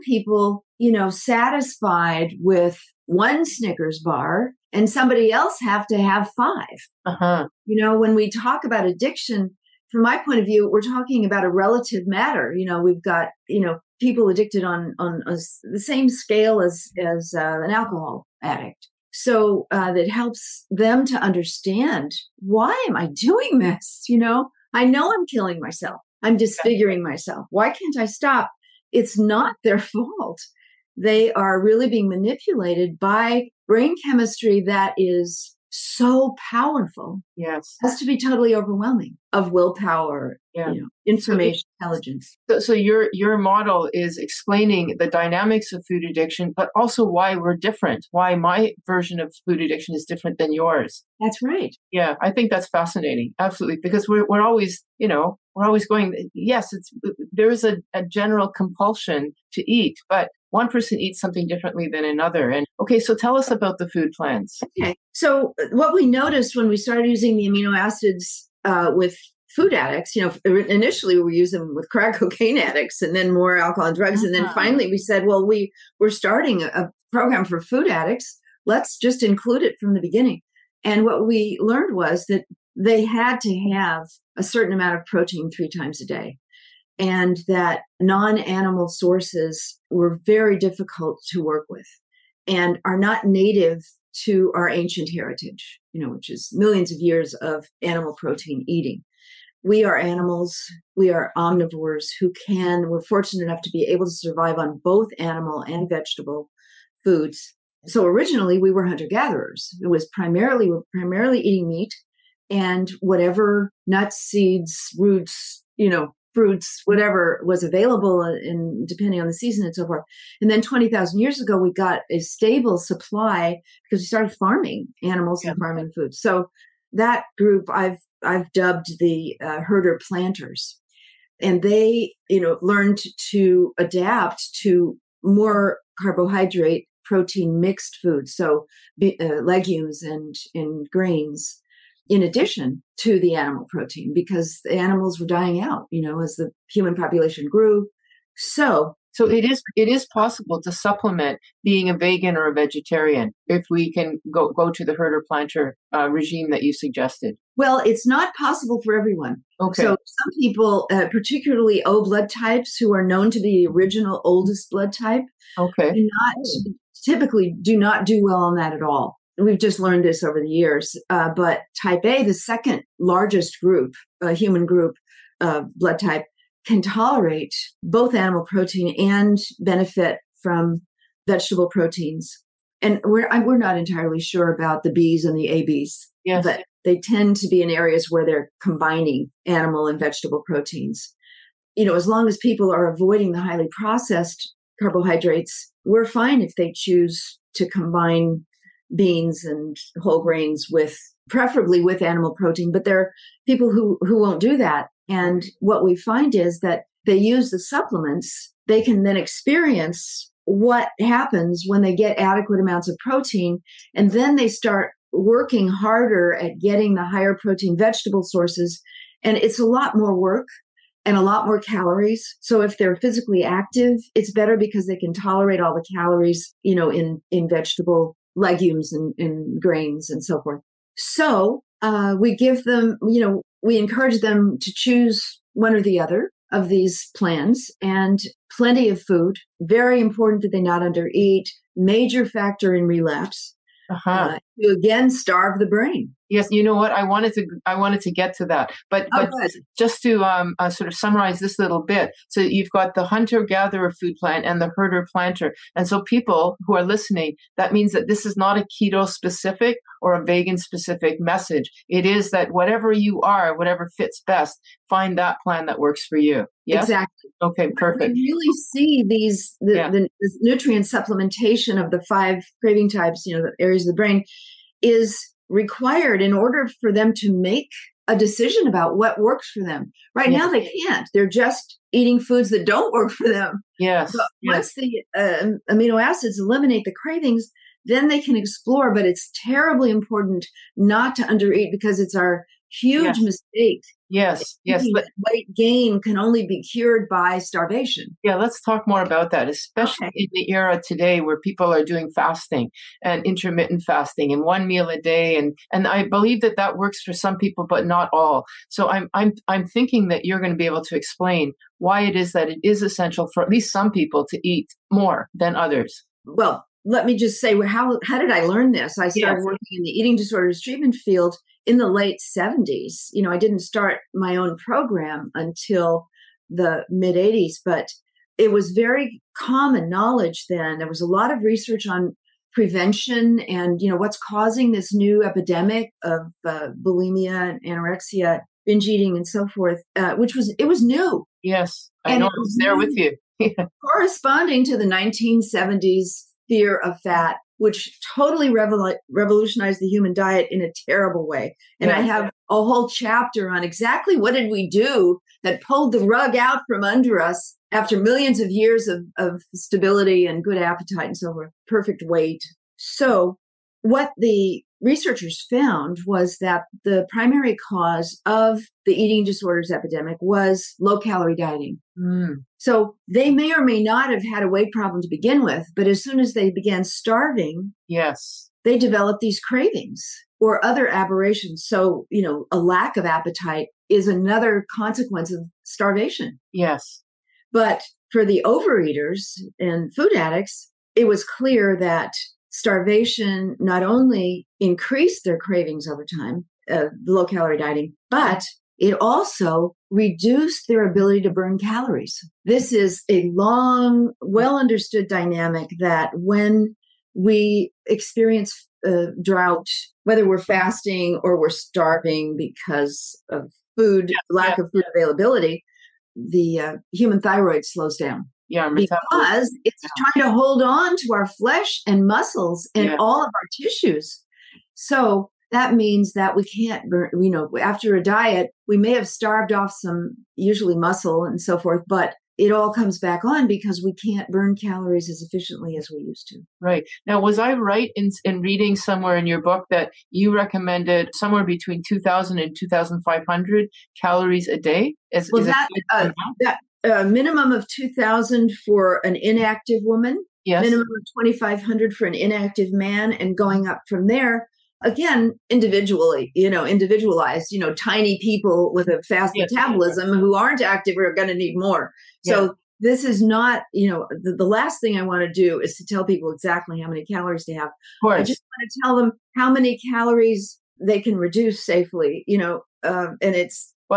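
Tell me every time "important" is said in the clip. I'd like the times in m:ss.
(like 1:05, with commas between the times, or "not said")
3:59, 4:49.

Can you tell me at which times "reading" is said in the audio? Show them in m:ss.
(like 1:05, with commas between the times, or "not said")
7:18.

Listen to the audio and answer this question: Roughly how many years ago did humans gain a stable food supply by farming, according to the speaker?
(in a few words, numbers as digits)
20,000 years.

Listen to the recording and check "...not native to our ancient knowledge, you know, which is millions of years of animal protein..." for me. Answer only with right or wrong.
wrong.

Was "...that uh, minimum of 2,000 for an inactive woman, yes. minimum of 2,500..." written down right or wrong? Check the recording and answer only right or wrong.
right.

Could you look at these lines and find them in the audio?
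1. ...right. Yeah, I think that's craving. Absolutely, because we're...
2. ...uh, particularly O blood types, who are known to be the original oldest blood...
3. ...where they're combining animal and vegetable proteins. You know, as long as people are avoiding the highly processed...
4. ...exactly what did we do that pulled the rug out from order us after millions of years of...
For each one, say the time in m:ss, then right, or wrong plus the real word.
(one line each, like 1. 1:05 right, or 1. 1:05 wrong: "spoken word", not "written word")
1. 0:51 wrong: "fascinating", not "craving"
2. 2:40 right
3. 3:08 right
4. 5:53 wrong: "under", not "order".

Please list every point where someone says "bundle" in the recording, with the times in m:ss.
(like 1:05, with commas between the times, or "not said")
not said.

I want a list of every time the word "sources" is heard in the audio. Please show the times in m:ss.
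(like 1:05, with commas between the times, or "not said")
1:28, 3:38.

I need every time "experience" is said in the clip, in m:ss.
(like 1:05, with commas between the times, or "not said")
3:29, 6:47.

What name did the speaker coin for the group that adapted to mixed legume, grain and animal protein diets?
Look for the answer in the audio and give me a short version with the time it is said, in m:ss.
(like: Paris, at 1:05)
herder planters, at 2:09.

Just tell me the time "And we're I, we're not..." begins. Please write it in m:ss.
3:02.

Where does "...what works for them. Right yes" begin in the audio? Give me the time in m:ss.
4:38.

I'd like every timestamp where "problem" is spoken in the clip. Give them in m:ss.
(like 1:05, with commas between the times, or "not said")
6:14.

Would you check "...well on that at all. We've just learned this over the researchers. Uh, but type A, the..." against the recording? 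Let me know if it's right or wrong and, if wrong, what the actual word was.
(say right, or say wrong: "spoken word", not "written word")
wrong: "years", not "researchers".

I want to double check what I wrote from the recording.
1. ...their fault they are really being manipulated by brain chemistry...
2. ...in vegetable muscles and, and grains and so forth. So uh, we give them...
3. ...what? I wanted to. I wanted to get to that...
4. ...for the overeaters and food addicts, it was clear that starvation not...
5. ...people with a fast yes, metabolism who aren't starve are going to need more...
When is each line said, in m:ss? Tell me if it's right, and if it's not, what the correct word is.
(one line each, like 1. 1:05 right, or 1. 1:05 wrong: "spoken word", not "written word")
1. 0:29 right
2. 3:47 wrong: "legumes", not "muscles"
3. 4:06 right
4. 6:28 right
5. 7:38 wrong: "active", not "starve".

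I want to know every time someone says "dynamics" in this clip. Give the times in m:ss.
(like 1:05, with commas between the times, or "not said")
0:45, 6:45.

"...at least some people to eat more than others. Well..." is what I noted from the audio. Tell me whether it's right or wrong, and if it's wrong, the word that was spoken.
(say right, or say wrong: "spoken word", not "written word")
right.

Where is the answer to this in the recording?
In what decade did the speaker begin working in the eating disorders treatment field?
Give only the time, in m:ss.
5:21.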